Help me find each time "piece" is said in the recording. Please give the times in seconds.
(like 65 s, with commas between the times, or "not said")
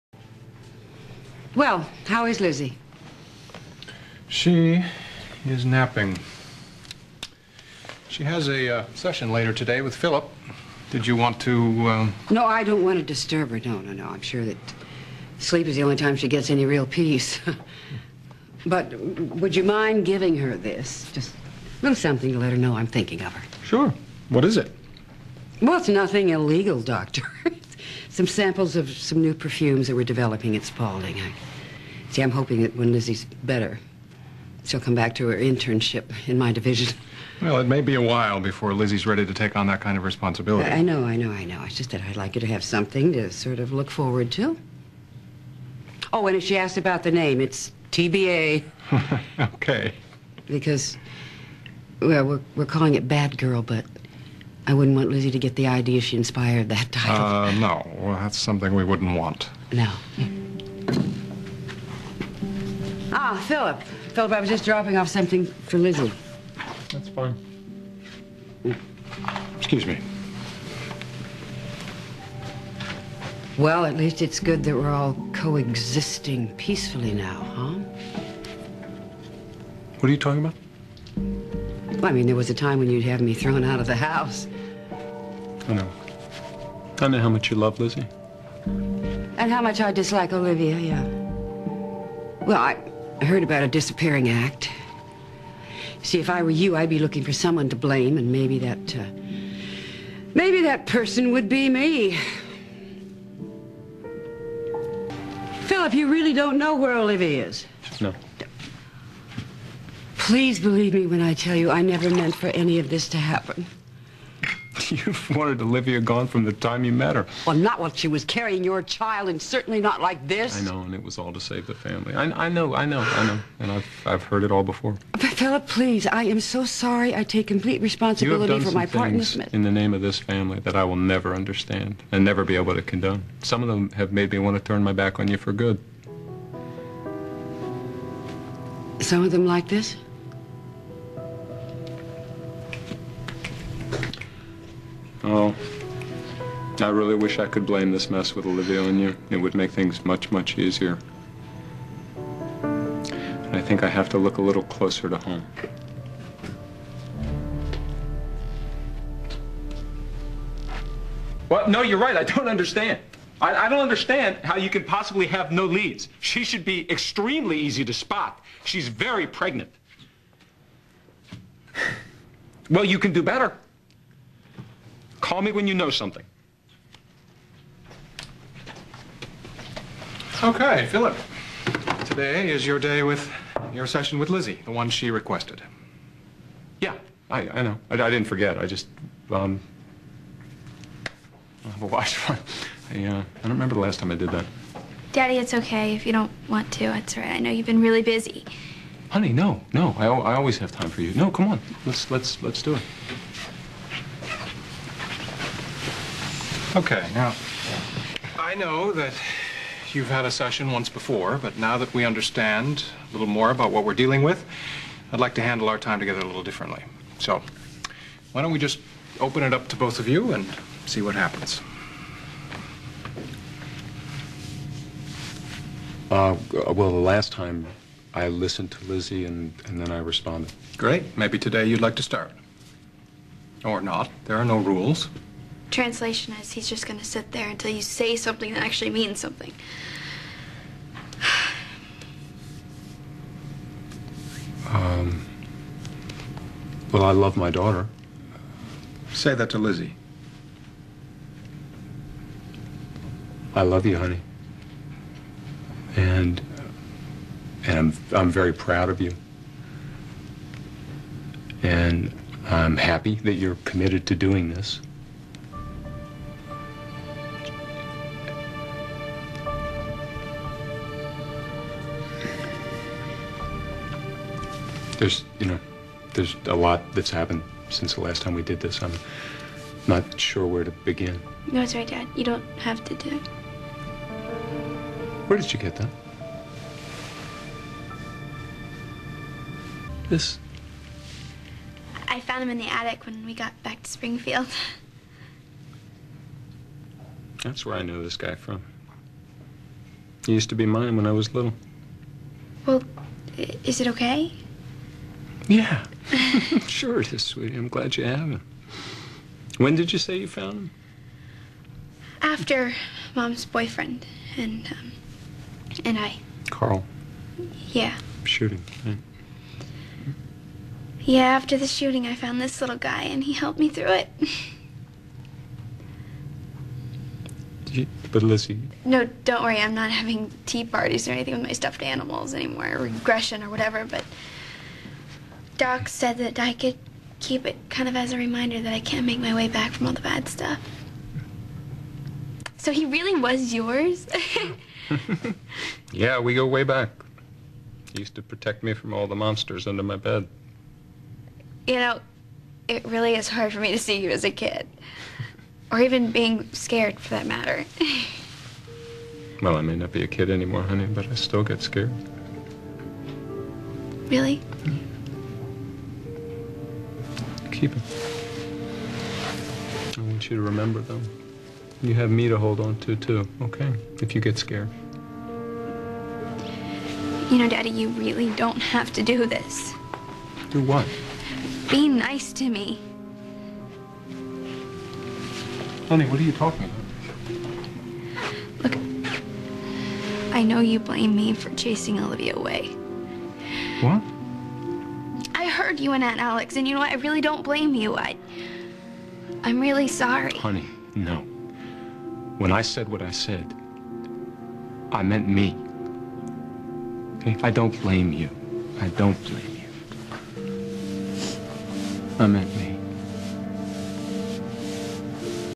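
not said.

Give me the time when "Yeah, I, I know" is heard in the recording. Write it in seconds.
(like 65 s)
186 s.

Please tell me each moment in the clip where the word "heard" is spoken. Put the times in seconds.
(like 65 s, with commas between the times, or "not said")
93 s, 124 s.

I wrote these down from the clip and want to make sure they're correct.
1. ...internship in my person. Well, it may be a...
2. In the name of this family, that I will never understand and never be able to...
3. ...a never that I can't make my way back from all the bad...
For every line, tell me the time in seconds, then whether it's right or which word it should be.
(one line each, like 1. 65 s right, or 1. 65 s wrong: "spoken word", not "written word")
1. 35 s wrong: "division", not "person"
2. 129 s right
3. 338 s wrong: "reminder", not "never".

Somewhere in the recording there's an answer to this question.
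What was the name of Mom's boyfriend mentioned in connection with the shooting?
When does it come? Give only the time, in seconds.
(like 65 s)
316 s.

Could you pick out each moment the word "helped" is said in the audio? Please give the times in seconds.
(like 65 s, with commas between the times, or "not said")
323 s.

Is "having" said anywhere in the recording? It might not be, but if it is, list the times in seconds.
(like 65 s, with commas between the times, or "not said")
329 s.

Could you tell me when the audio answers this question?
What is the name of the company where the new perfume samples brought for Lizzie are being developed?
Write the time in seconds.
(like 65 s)
30 s.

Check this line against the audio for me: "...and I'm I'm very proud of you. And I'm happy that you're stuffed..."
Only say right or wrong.
wrong.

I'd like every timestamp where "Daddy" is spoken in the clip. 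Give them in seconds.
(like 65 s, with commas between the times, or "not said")
195 s, 377 s.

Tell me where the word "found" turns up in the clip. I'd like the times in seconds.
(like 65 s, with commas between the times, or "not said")
292 s, 310 s, 322 s.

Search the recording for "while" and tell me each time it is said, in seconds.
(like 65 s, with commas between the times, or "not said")
38 s, 117 s.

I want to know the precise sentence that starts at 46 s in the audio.
Oh, and if she asked about the name, it's TBA.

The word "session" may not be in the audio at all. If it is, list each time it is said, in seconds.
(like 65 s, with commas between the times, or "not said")
8 s, 183 s, 210 s.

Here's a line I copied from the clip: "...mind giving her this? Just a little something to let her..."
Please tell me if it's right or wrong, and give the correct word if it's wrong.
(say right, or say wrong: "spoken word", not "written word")
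right.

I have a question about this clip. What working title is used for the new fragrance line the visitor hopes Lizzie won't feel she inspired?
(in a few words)
Bad Girl.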